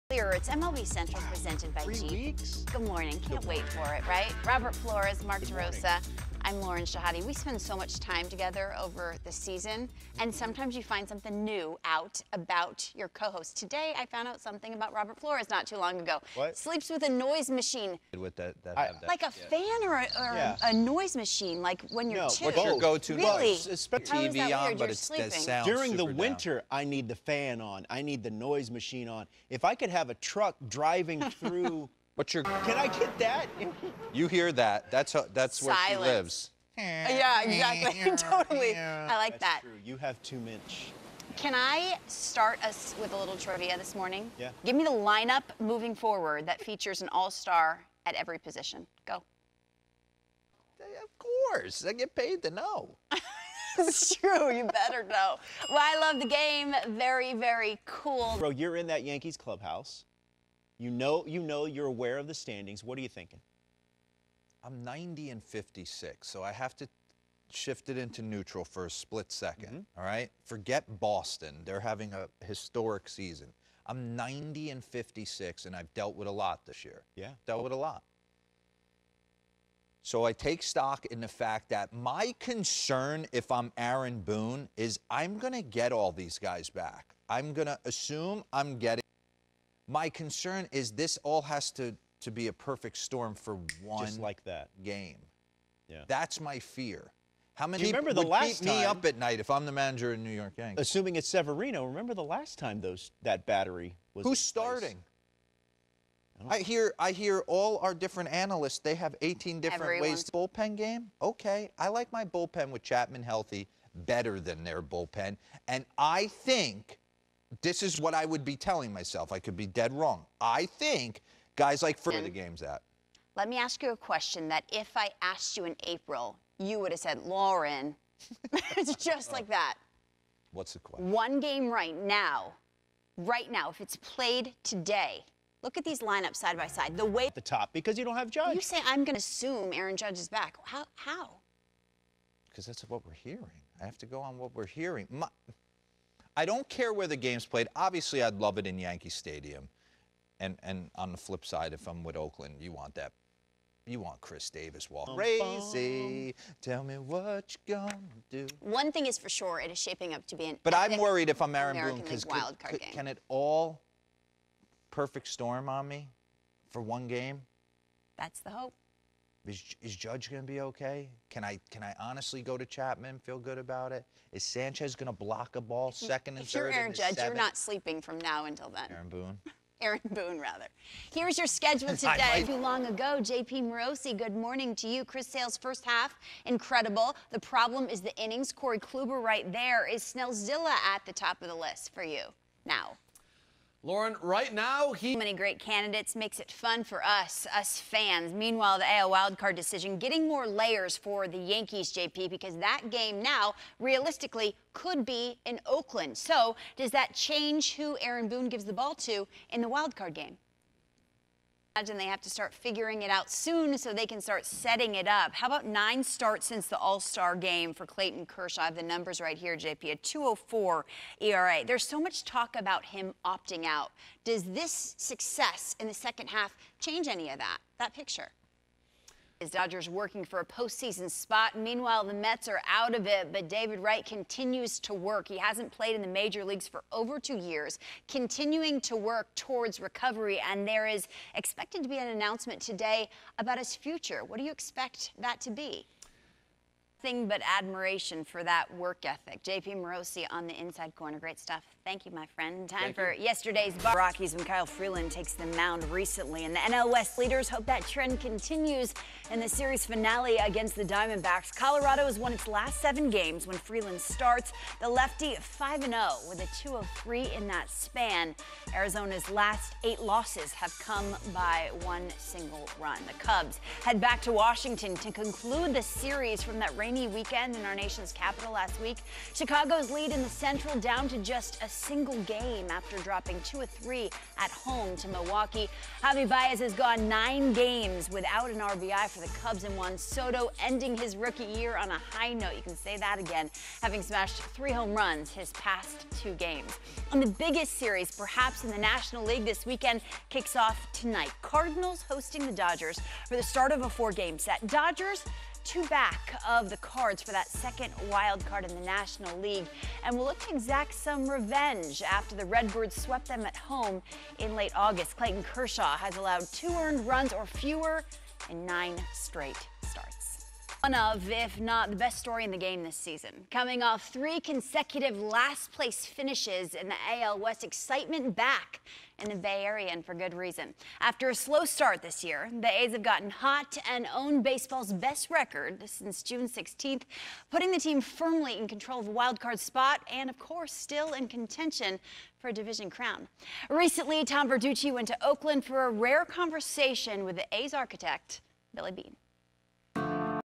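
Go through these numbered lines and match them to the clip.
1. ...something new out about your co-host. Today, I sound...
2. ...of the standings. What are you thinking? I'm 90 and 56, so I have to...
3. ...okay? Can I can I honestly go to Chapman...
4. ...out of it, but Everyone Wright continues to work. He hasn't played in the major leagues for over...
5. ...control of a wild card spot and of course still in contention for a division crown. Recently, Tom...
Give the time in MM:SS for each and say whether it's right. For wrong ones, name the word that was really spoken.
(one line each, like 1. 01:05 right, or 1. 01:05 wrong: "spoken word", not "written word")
1. 00:11 wrong: "found", not "sound"
2. 01:02 right
3. 02:50 right
4. 03:52 wrong: "David", not "Everyone"
5. 05:38 right.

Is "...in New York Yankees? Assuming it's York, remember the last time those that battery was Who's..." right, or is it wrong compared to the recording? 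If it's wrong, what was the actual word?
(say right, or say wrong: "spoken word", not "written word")
wrong: "Severino", not "York".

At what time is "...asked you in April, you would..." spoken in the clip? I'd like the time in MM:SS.
02:05.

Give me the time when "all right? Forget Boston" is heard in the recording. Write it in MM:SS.
01:09.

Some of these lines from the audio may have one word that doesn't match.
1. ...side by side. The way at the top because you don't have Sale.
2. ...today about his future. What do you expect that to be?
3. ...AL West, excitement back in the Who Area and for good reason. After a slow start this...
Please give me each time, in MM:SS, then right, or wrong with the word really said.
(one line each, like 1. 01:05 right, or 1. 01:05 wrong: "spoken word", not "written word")
1. 02:16 wrong: "Judge", not "Sale"
2. 04:02 right
3. 05:27 wrong: "Bay", not "Who".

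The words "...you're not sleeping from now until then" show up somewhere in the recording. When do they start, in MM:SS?
02:57.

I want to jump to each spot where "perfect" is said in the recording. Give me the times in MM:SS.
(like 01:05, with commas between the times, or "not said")
01:32, 02:44.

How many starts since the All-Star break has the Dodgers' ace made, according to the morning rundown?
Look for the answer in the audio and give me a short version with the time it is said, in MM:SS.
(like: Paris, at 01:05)
9, at 03:35.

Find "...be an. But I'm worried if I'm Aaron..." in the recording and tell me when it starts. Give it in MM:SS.
02:40.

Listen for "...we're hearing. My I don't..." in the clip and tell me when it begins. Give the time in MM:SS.
02:24.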